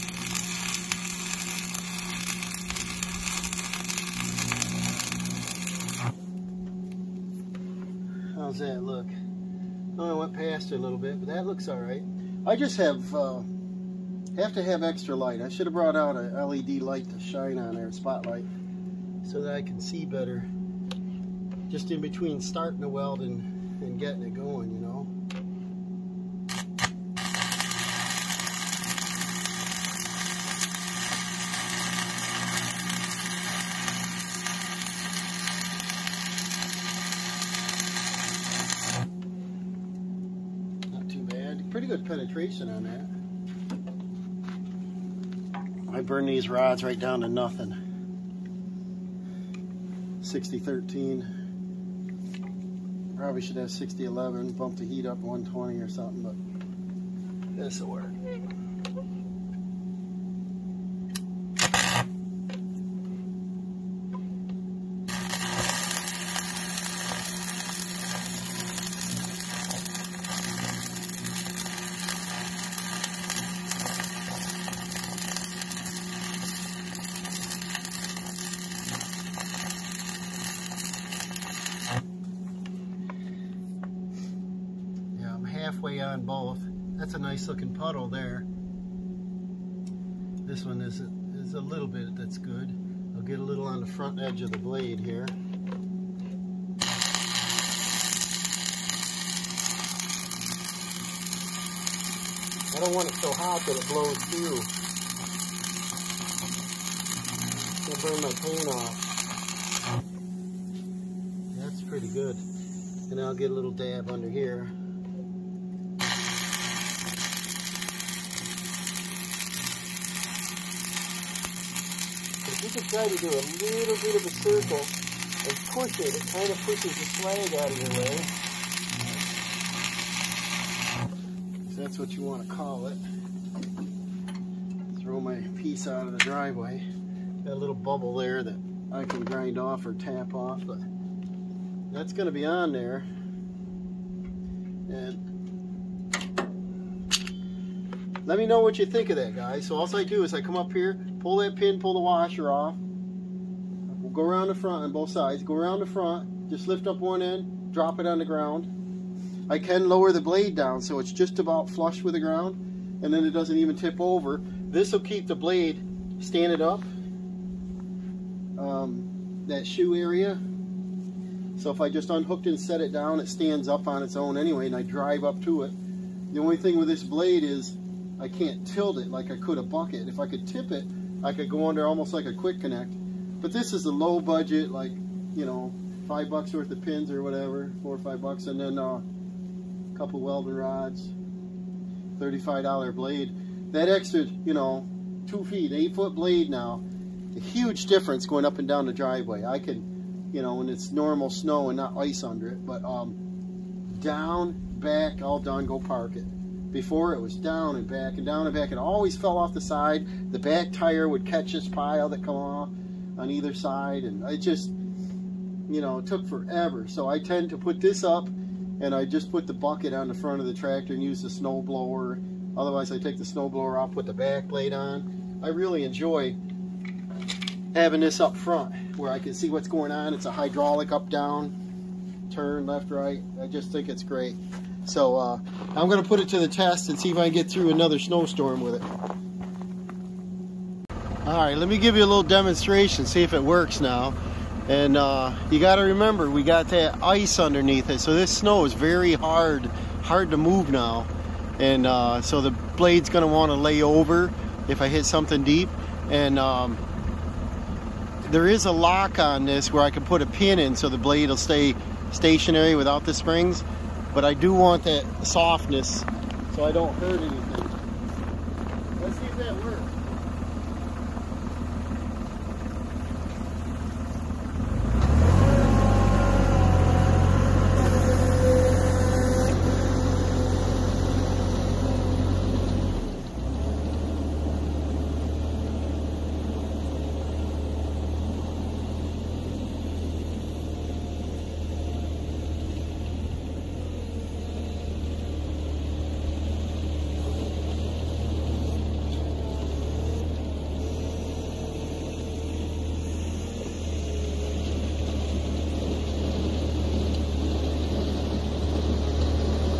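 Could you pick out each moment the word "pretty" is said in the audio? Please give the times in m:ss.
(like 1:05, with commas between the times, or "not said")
0:41, 1:51.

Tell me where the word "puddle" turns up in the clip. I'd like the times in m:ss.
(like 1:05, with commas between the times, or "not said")
1:27.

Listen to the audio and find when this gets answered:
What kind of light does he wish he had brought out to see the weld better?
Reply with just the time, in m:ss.
0:16.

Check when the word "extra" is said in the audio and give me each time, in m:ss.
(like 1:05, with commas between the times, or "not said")
0:14, 3:13.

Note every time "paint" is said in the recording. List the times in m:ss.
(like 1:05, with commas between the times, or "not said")
1:48.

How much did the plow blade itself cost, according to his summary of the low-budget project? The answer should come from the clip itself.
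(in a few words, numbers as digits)
$35.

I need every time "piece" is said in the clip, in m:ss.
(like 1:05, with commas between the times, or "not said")
2:15.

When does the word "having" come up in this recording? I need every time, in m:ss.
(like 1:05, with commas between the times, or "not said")
3:47.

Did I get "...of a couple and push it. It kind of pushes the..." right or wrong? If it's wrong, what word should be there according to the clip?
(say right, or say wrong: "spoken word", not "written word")
wrong: "circle", not "couple".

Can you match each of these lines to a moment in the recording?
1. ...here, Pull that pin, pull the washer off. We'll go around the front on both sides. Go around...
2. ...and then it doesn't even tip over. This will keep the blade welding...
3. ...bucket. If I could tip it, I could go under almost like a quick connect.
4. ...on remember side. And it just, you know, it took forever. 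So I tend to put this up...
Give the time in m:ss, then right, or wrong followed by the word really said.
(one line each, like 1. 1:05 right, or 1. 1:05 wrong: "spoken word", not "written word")
1. 2:30 right
2. 2:43 wrong: "standing", not "welding"
3. 2:59 right
4. 3:33 wrong: "either", not "remember".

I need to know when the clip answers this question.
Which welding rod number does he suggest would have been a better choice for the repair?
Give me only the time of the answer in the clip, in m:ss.
0:53.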